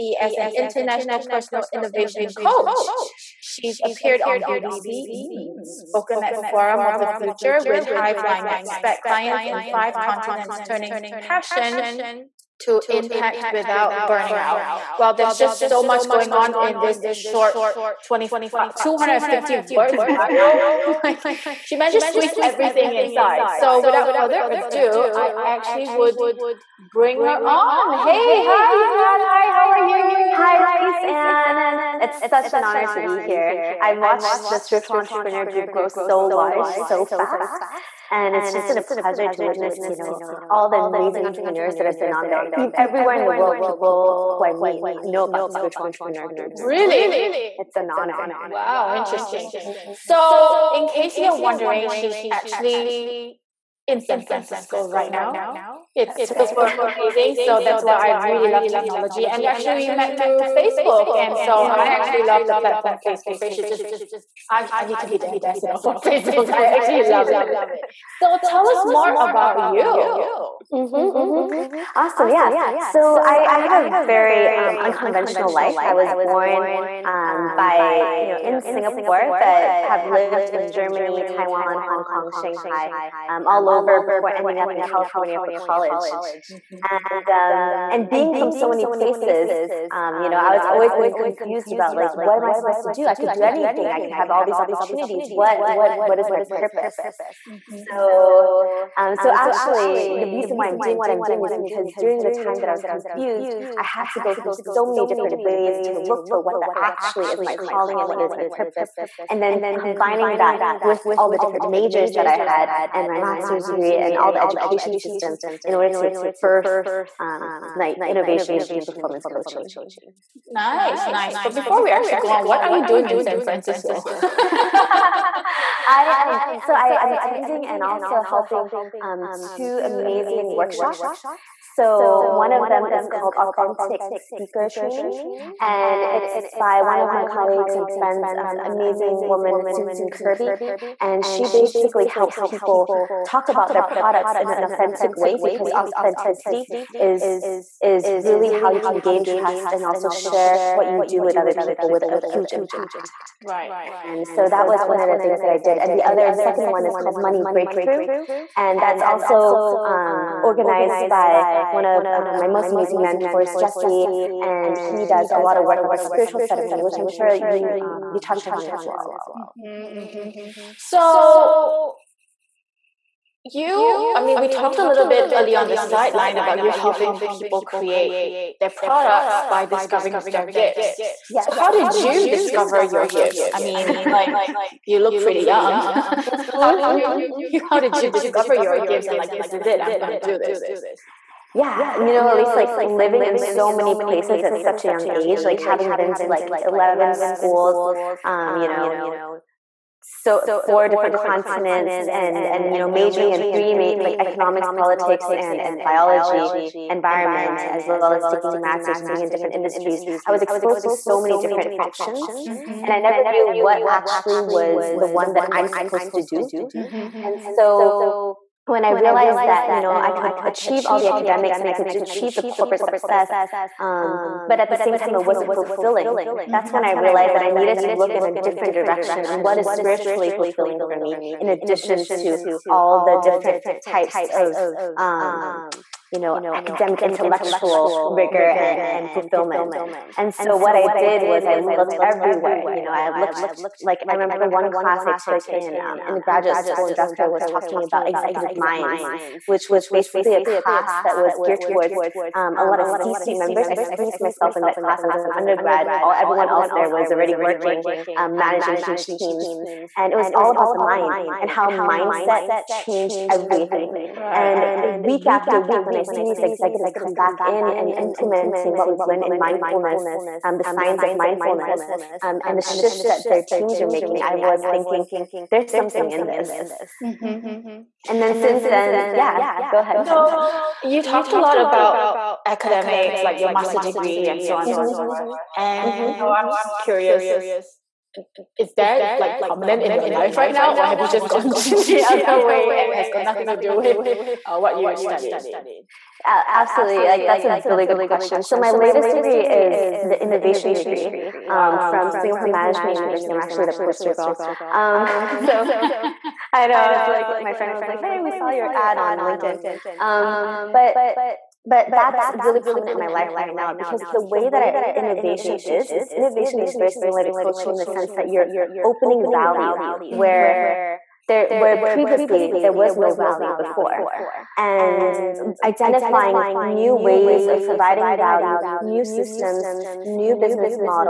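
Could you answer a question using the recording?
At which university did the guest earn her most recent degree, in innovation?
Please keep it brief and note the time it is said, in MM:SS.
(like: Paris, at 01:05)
Singapore Management University, at 05:02.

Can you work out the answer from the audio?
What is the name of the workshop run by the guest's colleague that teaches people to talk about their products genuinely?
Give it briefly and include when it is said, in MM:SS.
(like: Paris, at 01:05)
Authentic speaker training, at 02:13.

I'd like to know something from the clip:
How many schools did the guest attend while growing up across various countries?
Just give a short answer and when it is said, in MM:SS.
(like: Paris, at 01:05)
11, at 03:16.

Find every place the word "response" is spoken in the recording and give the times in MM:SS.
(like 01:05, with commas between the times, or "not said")
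not said.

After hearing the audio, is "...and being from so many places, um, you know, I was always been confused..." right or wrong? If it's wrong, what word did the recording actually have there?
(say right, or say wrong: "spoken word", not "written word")
right.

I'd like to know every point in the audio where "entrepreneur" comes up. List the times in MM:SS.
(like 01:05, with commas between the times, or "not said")
00:34, 00:41, 00:45.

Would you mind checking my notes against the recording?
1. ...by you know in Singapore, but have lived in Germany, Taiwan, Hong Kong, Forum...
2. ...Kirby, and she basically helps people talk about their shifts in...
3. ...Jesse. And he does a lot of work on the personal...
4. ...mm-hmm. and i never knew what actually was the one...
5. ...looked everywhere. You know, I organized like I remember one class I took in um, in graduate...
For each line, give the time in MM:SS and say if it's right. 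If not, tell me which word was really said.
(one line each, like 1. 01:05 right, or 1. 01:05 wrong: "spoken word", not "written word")
1. 01:17 wrong: "Shanghai", not "Forum"
2. 02:20 wrong: "products", not "shifts"
3. 02:43 wrong: "spiritual", not "personal"
4. 03:32 right
5. 04:01 wrong: "looked", not "organized".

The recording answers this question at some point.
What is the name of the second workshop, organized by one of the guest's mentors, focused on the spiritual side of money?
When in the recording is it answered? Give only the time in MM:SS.
02:37.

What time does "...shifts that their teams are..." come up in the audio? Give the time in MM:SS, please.
04:32.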